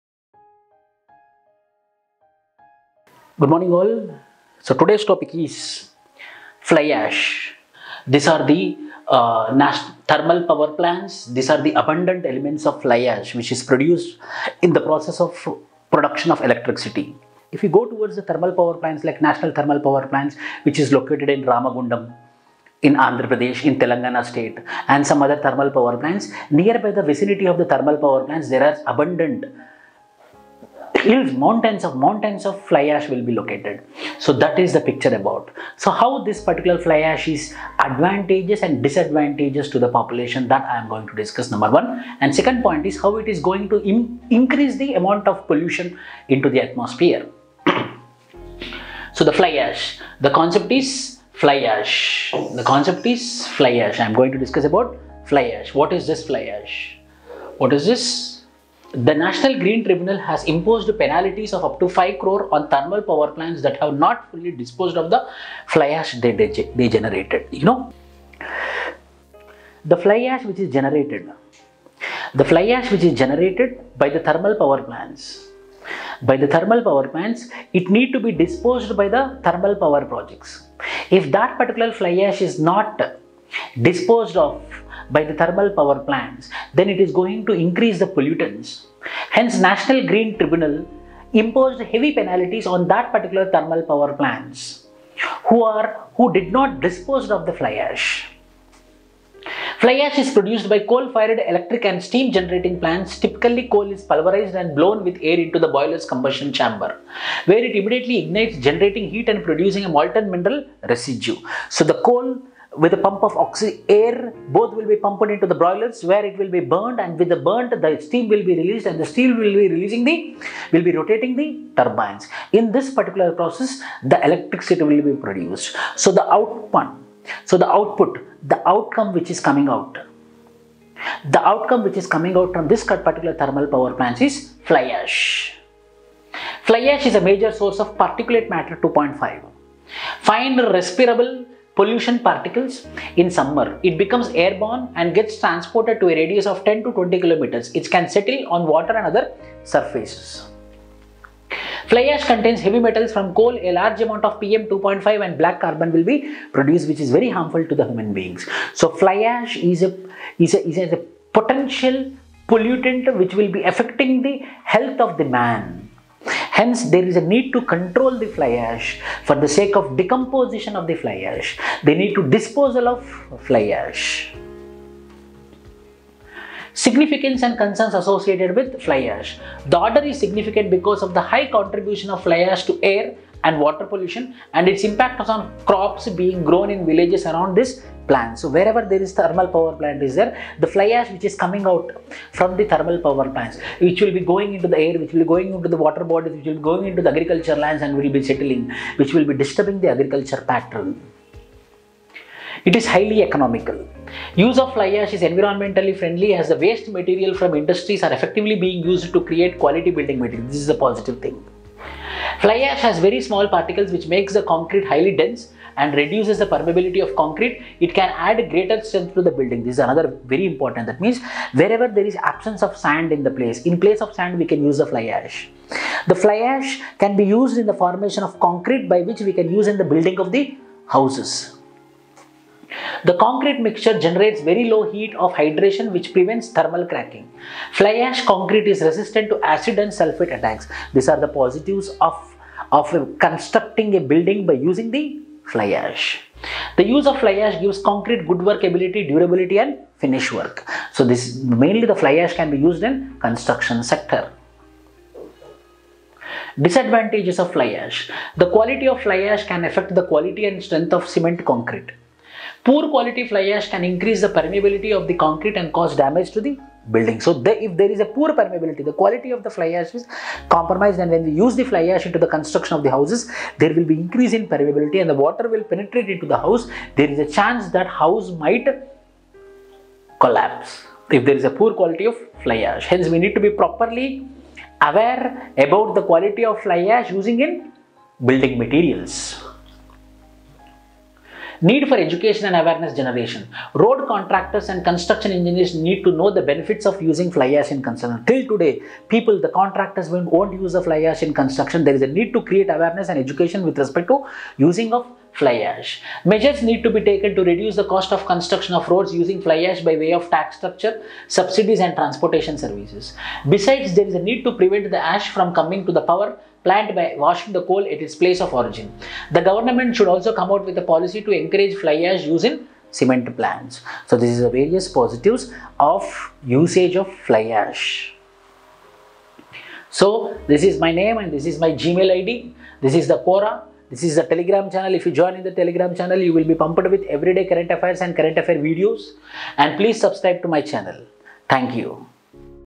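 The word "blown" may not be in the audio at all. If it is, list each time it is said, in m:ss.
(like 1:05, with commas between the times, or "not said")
1:44.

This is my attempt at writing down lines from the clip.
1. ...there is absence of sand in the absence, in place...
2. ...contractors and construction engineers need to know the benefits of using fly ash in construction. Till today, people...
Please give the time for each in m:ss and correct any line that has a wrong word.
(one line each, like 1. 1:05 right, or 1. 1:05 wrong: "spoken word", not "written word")
1. 3:41 wrong: "place", not "absence"
2. 4:54 right.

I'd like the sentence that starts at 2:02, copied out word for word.
In this particular process, the electricity will be produced.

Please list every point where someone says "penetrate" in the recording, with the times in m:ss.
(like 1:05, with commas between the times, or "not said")
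4:35.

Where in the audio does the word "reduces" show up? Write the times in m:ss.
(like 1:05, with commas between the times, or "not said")
3:35, 5:07.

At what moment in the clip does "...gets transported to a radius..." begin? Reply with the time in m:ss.
2:25.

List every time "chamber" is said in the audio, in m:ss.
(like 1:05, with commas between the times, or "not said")
1:46.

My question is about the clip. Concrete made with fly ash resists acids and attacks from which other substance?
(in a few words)
sulfate.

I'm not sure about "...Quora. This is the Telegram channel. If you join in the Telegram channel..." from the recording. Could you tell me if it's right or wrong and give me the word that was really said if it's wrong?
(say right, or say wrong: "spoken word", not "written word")
right.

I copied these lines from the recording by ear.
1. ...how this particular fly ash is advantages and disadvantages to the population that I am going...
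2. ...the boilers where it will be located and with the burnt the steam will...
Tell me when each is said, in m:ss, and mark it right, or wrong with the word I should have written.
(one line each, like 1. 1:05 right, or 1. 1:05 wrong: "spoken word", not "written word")
1. 0:35 right
2. 1:55 wrong: "burned", not "located".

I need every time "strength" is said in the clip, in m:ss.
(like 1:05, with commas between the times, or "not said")
3:38, 4:20.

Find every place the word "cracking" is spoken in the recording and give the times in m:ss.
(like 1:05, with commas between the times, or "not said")
3:56.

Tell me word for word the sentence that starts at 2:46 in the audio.
Hence, there is a need to control the fly ash for the sake of decomposition of the fly ash.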